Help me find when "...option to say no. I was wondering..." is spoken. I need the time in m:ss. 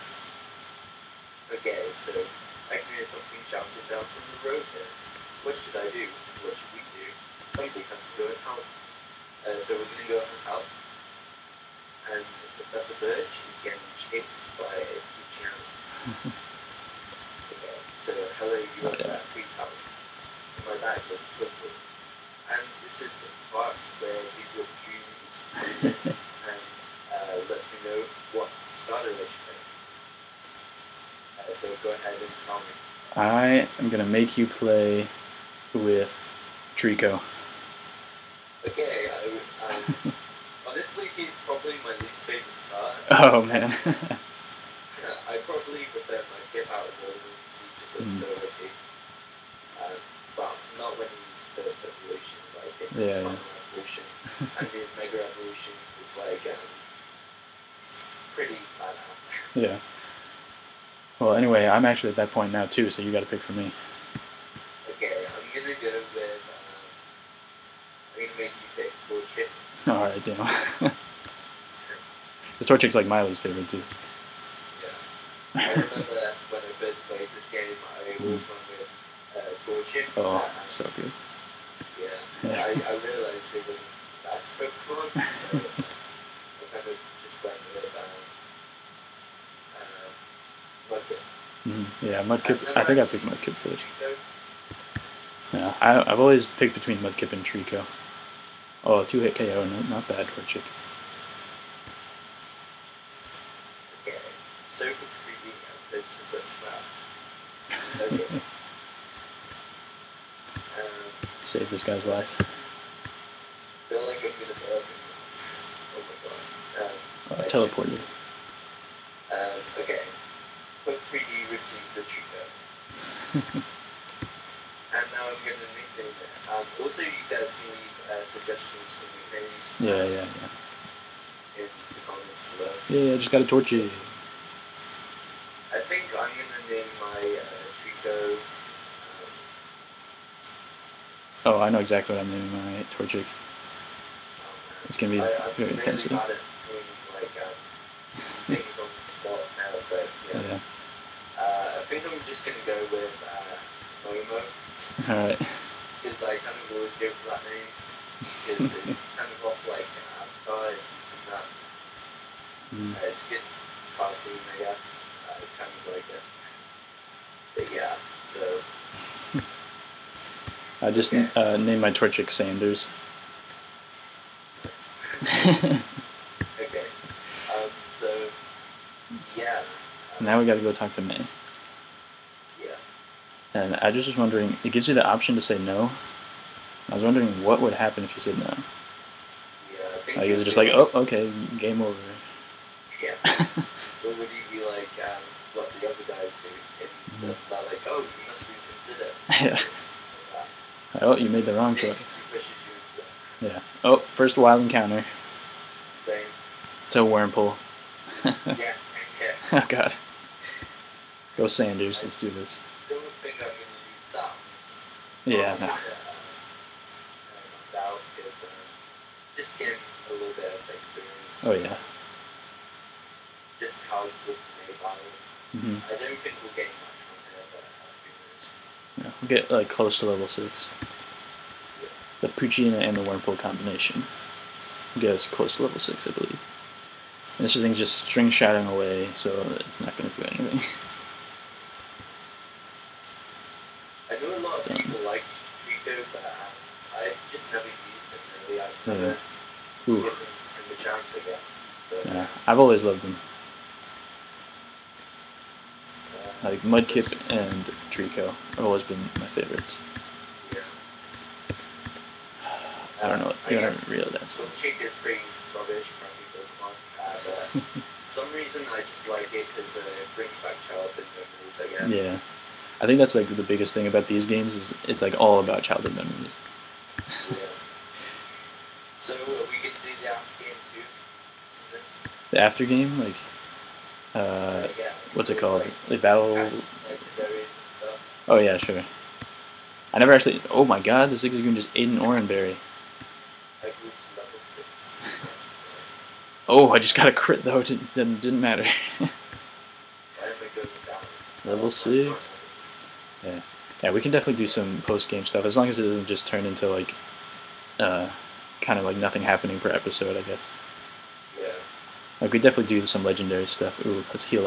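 3:05.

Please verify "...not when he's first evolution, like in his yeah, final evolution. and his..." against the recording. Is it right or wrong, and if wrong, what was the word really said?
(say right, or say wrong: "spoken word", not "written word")
right.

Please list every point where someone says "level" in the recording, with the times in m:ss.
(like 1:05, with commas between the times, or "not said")
3:50, 3:55, 5:01.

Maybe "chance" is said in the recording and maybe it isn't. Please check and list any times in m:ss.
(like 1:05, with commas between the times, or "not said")
4:10.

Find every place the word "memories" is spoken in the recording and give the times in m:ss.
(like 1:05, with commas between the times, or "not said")
4:31, 4:35.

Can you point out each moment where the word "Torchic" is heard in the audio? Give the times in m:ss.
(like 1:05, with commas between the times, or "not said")
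1:12, 1:19, 2:22, 2:51.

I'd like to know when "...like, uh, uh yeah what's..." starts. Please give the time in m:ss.
4:42.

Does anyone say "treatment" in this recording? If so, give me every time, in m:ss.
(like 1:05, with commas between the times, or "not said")
2:03.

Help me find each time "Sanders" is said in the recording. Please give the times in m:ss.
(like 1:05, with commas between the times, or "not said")
2:52, 3:31.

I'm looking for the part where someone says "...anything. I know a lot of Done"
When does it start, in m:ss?
4:00.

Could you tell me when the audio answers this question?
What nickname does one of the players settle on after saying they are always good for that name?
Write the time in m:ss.
2:34.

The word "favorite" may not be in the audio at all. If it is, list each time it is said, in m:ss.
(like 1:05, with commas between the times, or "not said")
1:13, 4:19.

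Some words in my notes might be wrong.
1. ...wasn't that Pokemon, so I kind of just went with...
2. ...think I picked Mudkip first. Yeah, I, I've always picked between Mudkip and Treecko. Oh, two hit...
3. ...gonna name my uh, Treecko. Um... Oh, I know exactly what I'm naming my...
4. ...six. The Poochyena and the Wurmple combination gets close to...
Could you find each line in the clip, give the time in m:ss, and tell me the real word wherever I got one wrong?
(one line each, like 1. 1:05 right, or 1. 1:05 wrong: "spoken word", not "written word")
1. 1:23 right
2. 1:32 right
3. 2:16 right
4. 3:50 right.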